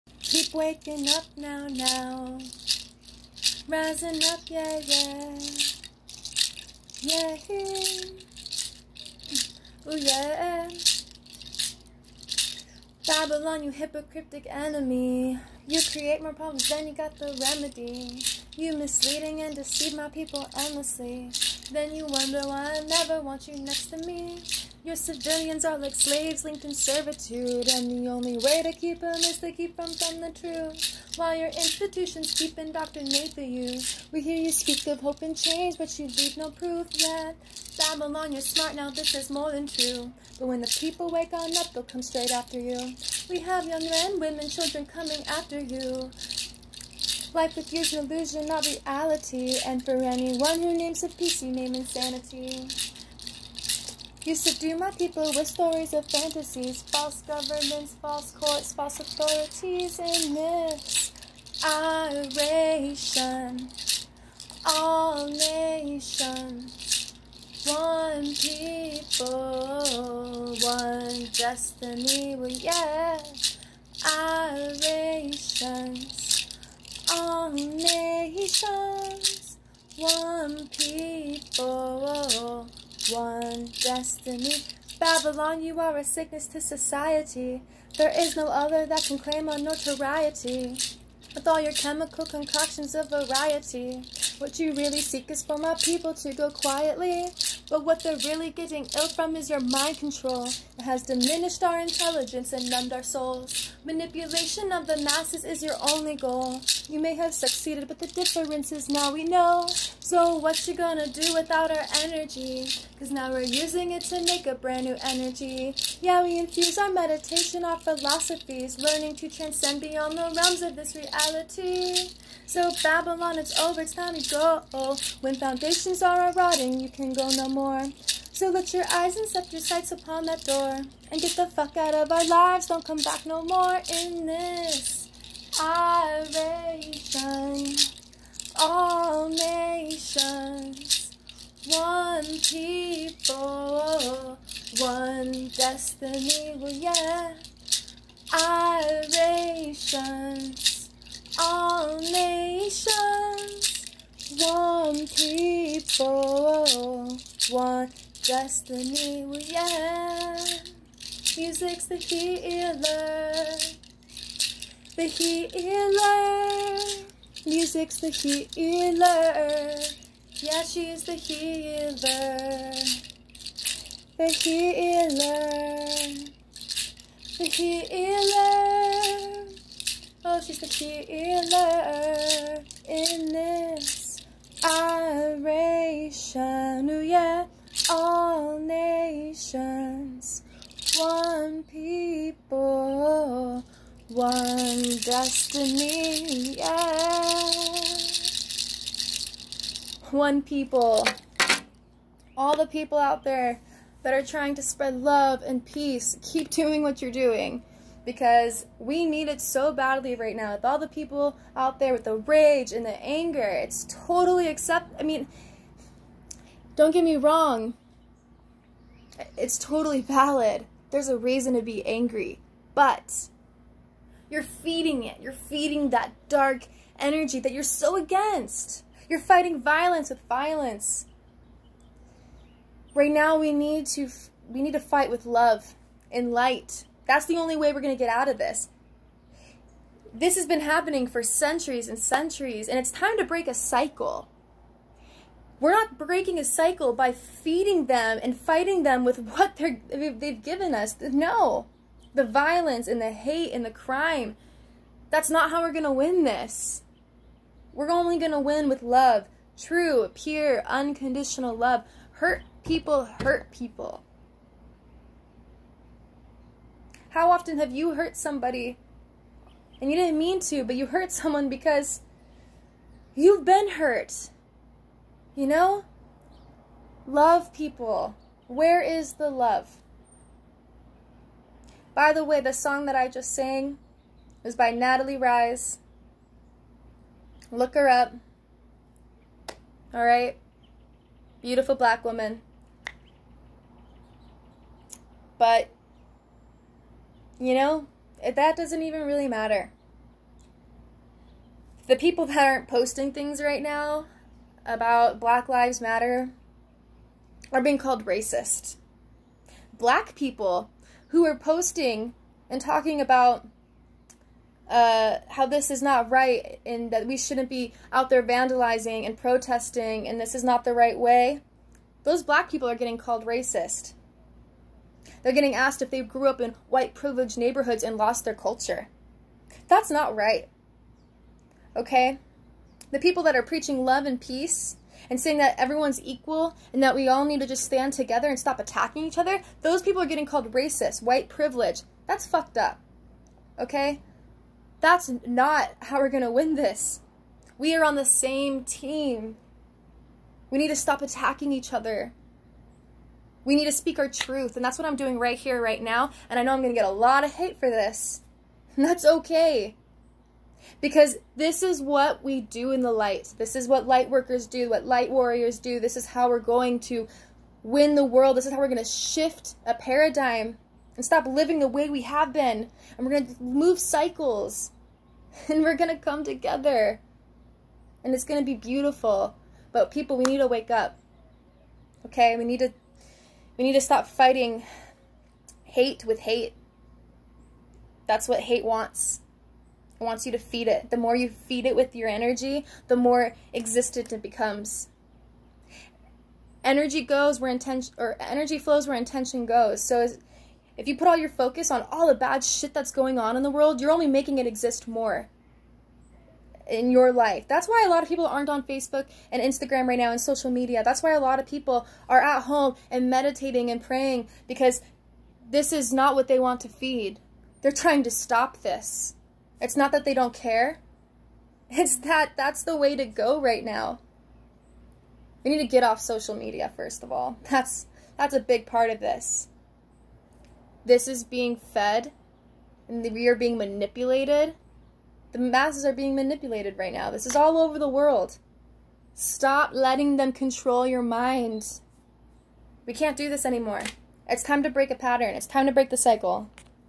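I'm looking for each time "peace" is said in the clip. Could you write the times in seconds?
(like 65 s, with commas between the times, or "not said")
51 s, 205 s, 334 s.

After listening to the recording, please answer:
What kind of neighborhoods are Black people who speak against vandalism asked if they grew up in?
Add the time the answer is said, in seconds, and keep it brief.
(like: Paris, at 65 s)
white privileged neighborhoods, at 326 s.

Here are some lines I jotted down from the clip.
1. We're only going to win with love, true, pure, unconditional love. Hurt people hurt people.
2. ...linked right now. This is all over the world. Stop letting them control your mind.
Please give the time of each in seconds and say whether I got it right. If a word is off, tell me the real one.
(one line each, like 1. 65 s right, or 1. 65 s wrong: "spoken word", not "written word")
1. 257 s right
2. 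436 s wrong: "manipulated", not "linked".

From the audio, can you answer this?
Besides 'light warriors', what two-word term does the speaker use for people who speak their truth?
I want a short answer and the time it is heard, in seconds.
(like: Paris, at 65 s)
light workers, at 363 s.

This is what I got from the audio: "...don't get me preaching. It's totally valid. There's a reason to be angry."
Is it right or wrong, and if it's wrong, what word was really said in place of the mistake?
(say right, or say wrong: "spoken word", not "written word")
wrong: "wrong", not "preaching".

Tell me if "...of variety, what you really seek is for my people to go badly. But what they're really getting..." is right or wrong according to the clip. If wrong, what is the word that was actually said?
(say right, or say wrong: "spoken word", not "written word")
wrong: "quietly", not "badly".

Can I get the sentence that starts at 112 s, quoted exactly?
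Cause now we're using it to make a brand new energy.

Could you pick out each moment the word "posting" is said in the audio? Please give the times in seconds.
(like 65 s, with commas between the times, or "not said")
302 s, 311 s.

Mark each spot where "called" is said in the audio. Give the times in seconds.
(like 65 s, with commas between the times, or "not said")
307 s, 322 s, 340 s.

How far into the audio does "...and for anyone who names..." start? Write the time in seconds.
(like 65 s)
49 s.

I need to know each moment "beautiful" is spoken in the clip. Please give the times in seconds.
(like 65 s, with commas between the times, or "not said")
291 s, 378 s.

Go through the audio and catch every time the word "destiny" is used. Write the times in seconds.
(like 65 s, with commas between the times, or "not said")
71 s, 83 s, 145 s, 158 s, 195 s.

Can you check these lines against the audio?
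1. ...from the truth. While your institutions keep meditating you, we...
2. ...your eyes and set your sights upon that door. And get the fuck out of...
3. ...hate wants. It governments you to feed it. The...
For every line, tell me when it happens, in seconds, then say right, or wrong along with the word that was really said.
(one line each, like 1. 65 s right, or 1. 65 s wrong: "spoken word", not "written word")
1. 29 s wrong: "indoctrinating", not "meditating"
2. 128 s right
3. 388 s wrong: "wants", not "governments".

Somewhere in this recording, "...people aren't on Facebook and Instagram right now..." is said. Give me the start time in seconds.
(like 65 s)
408 s.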